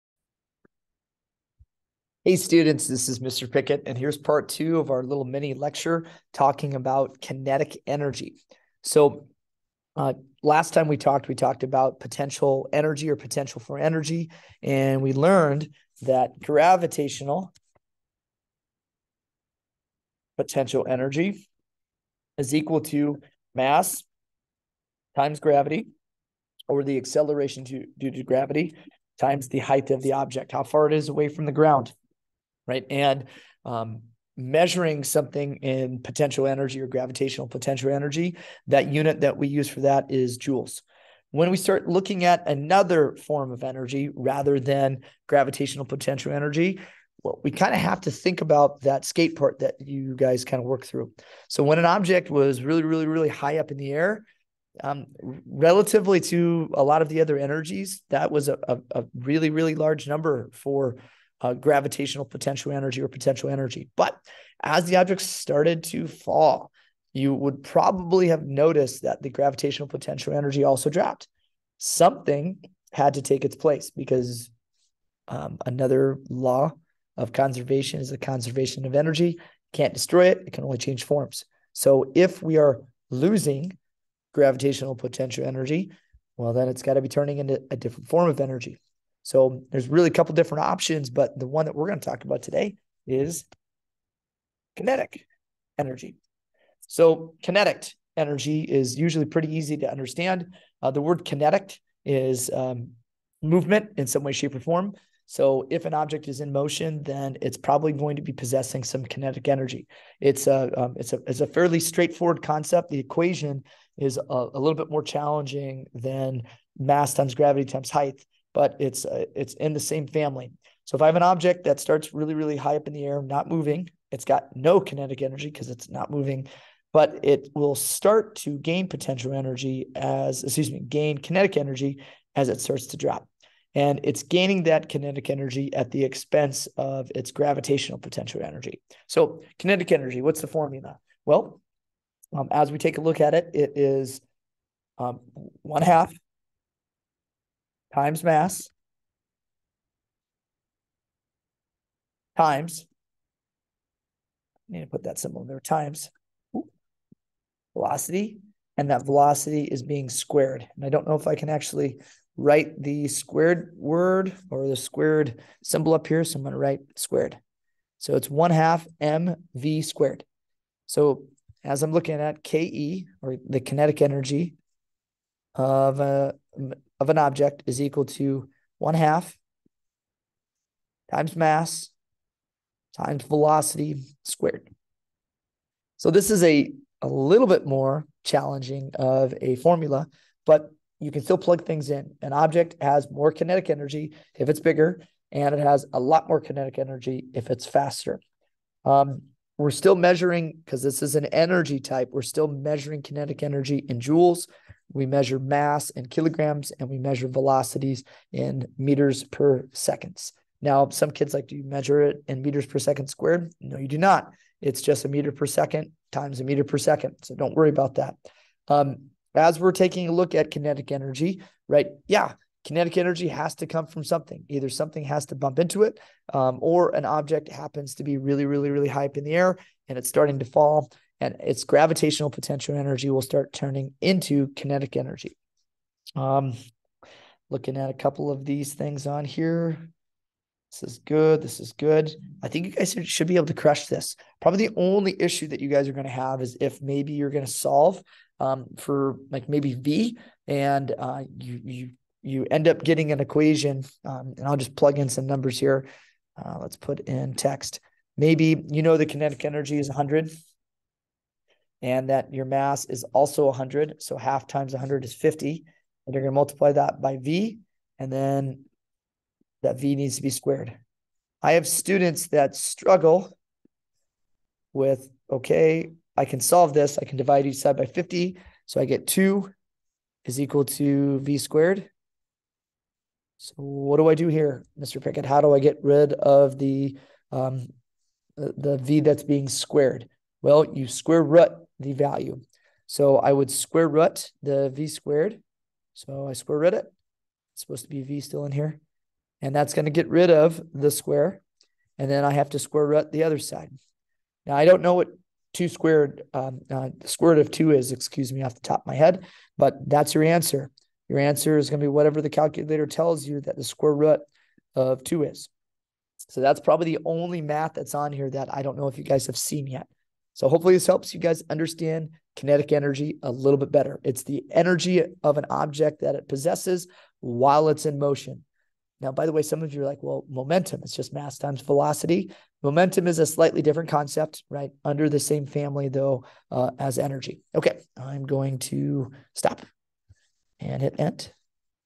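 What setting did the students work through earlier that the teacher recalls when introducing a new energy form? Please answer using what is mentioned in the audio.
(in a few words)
skate park.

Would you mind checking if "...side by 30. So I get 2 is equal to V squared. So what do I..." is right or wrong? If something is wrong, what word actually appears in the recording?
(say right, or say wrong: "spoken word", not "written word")
wrong: "50", not "30".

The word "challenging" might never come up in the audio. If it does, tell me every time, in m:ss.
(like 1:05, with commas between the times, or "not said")
1:55, 3:08.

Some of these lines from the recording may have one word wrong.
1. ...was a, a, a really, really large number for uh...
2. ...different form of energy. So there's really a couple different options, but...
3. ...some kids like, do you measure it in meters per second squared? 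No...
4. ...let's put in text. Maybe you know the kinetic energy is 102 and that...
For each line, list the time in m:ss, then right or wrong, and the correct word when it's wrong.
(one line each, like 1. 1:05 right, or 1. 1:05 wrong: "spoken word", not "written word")
1. 0:58 right
2. 1:27 right
3. 3:30 right
4. 4:16 wrong: "100", not "102".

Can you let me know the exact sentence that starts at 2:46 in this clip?
So I'm going to write squared.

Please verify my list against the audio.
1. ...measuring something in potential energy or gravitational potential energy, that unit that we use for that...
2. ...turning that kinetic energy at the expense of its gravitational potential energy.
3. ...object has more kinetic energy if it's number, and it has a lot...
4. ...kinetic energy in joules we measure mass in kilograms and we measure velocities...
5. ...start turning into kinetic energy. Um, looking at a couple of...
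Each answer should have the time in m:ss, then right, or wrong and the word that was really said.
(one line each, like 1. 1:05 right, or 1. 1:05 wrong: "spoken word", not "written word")
1. 0:34 right
2. 2:14 wrong: "gaining", not "turning"
3. 3:12 wrong: "bigger", not "number"
4. 3:23 right
5. 3:53 right.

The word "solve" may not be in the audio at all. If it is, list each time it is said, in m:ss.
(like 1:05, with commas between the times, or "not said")
4:07, 4:36.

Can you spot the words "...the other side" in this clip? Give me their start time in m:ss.
5:03.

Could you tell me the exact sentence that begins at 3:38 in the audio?
Um, as we're taking a look at kinetic energy, right?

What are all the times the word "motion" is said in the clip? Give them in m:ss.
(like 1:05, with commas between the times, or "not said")
1:46, 5:27.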